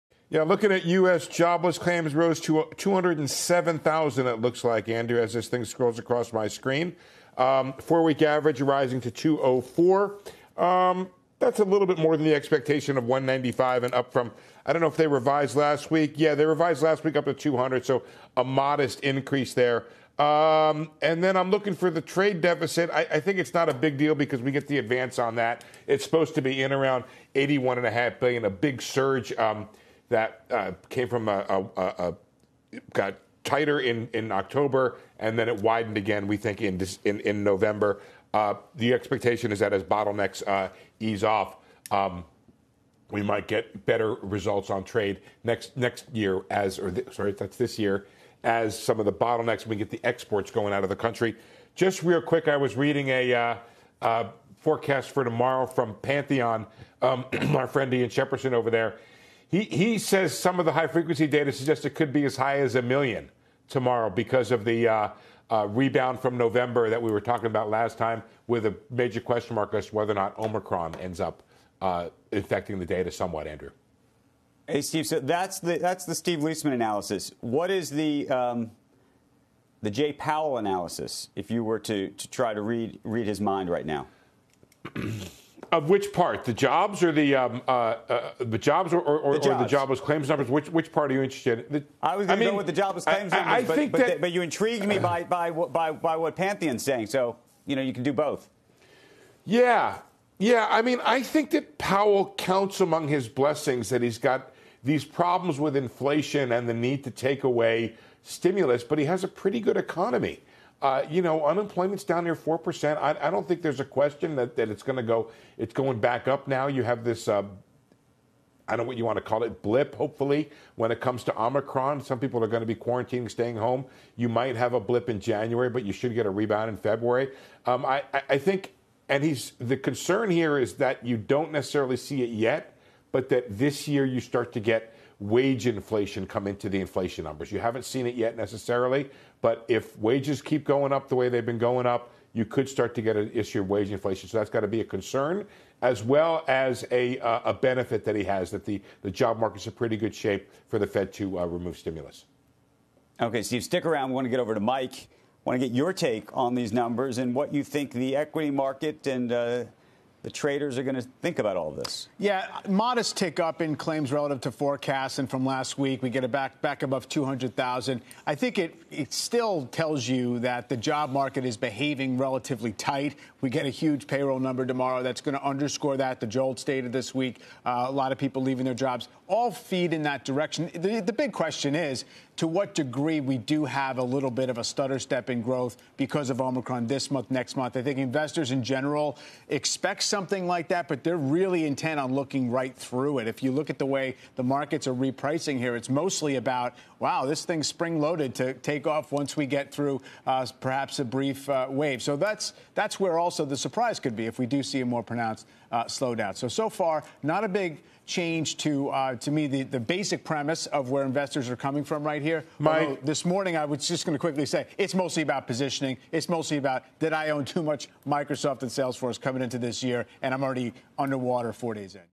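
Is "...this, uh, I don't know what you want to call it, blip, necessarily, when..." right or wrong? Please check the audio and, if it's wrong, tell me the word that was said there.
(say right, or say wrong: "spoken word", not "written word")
wrong: "hopefully", not "necessarily".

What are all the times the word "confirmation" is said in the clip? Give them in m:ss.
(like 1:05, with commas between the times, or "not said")
not said.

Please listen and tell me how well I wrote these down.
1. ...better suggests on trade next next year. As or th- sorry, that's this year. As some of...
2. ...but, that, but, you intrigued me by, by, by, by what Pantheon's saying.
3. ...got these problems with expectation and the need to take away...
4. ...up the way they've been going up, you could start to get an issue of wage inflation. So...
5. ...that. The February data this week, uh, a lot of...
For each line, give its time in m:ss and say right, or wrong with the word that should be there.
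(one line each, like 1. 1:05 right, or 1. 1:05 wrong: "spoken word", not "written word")
1. 0:43 wrong: "results", not "suggests"
2. 1:33 right
3. 1:44 wrong: "inflation", not "expectation"
4. 2:20 right
5. 2:55 wrong: "JOLTS", not "February".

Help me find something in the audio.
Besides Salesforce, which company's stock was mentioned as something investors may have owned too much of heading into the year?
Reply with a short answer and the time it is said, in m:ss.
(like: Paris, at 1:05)
Microsoft, at 3:38.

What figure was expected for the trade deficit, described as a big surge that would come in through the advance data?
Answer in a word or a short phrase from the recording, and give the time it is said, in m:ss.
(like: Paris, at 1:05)
81.5 billion, at 0:27.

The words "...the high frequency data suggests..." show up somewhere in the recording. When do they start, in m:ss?
1:00.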